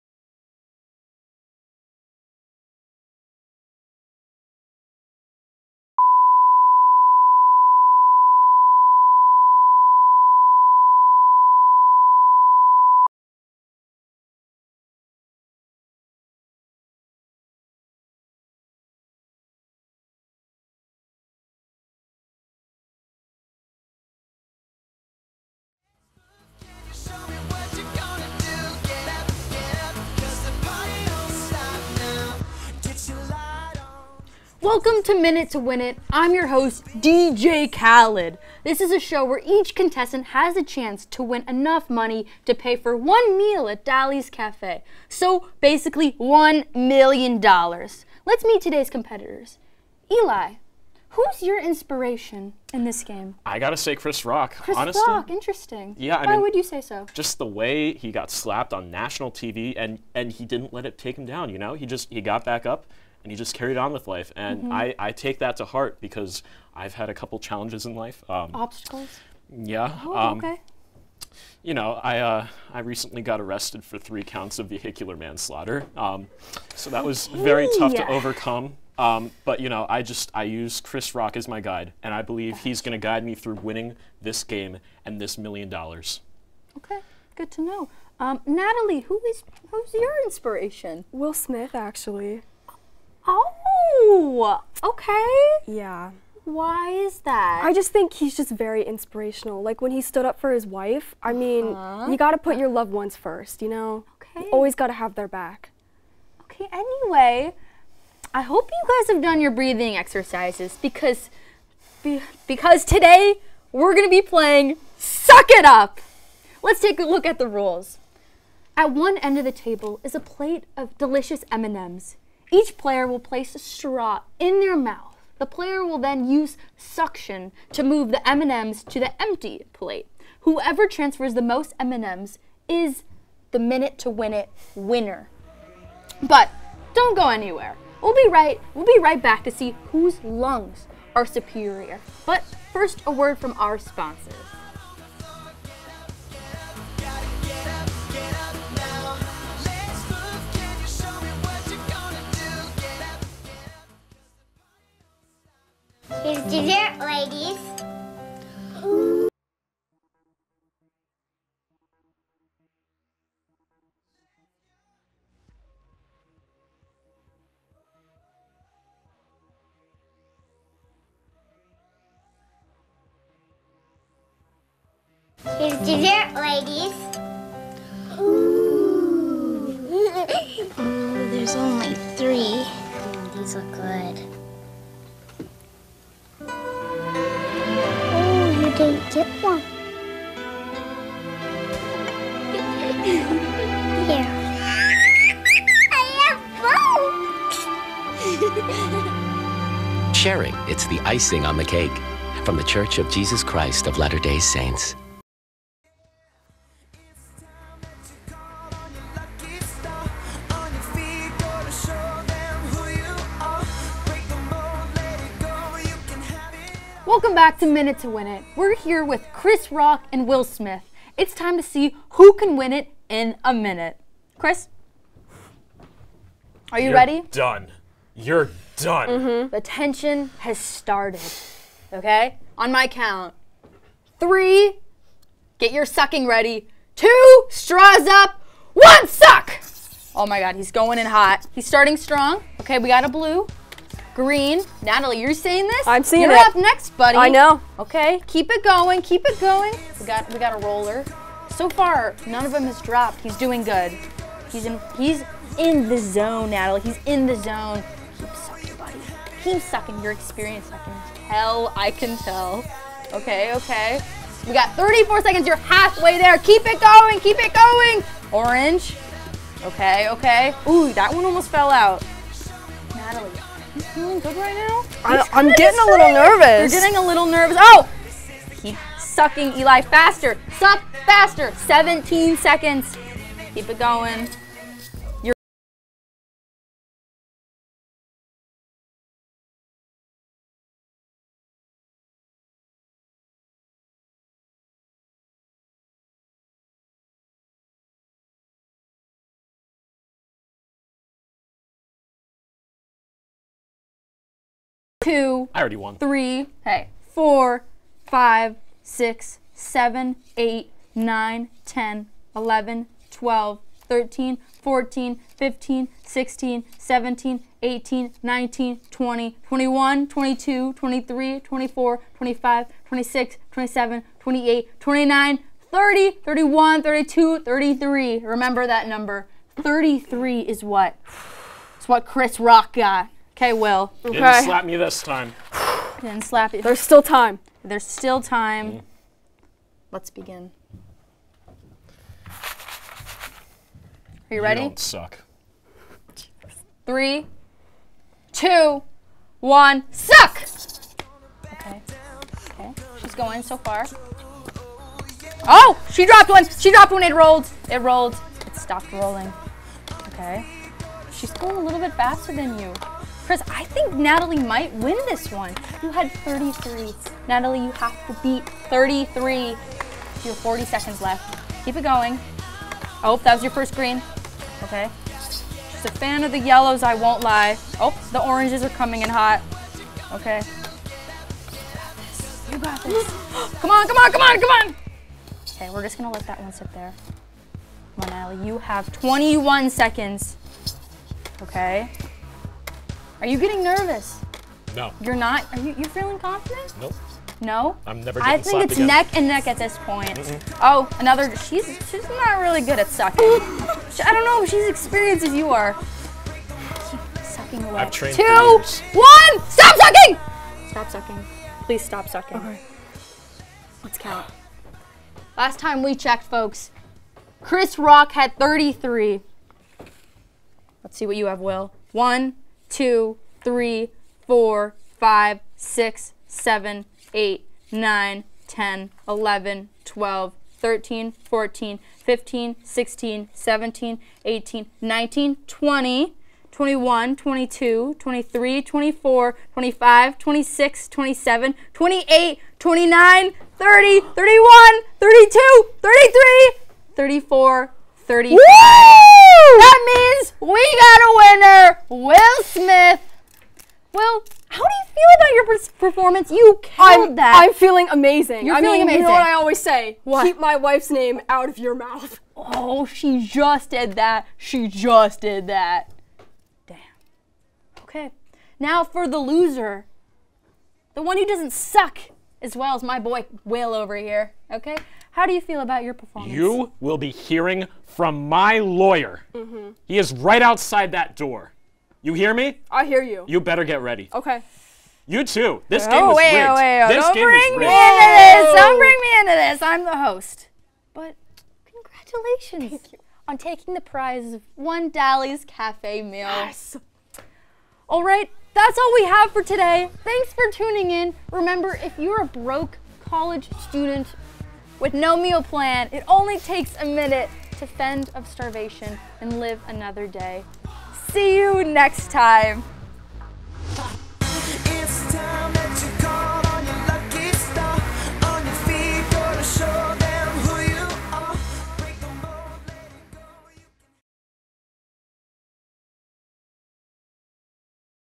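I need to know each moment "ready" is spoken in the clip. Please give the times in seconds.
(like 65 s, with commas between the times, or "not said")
226 s, 236 s, 344 s, 483 s.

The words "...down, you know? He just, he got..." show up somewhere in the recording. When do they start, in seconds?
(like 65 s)
61 s.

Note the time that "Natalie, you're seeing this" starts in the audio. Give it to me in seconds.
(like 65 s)
244 s.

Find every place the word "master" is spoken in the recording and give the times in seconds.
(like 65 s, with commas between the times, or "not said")
not said.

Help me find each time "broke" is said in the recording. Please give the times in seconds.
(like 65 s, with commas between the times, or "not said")
502 s.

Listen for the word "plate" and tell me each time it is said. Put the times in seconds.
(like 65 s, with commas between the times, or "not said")
120 s, 129 s.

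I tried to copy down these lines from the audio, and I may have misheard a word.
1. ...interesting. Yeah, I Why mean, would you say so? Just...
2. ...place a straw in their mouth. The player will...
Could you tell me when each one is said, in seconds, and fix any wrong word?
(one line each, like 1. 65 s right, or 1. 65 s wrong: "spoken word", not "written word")
1. 55 s right
2. 123 s right.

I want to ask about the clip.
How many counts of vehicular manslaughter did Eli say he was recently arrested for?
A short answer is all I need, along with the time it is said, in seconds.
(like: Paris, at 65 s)
3, at 73 s.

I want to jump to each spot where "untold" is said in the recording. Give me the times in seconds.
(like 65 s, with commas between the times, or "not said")
not said.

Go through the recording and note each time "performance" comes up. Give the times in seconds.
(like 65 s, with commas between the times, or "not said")
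455 s, 475 s.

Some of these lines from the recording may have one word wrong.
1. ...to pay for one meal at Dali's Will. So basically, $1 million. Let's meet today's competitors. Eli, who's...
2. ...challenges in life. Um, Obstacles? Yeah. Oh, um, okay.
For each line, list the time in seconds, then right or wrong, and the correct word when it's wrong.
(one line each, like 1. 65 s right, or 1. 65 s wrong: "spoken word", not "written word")
1. 42 s wrong: "Cafe", not "Will"
2. 67 s right.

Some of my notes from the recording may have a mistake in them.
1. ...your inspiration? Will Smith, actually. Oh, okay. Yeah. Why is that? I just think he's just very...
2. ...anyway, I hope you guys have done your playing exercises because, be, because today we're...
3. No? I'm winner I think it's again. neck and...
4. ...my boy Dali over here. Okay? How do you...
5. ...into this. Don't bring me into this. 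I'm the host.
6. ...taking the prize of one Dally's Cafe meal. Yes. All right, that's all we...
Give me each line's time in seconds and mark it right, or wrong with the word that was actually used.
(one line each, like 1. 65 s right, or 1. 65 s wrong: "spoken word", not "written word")
1. 89 s right
2. 106 s wrong: "breathing", not "playing"
3. 397 s wrong: "never", not "winner"
4. 472 s wrong: "Will", not "Dali"
5. 488 s right
6. 493 s right.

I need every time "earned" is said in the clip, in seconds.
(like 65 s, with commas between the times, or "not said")
not said.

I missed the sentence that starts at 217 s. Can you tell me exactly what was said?
Welcome back to Minute to Win It.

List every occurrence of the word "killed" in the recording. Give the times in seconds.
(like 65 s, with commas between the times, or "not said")
456 s.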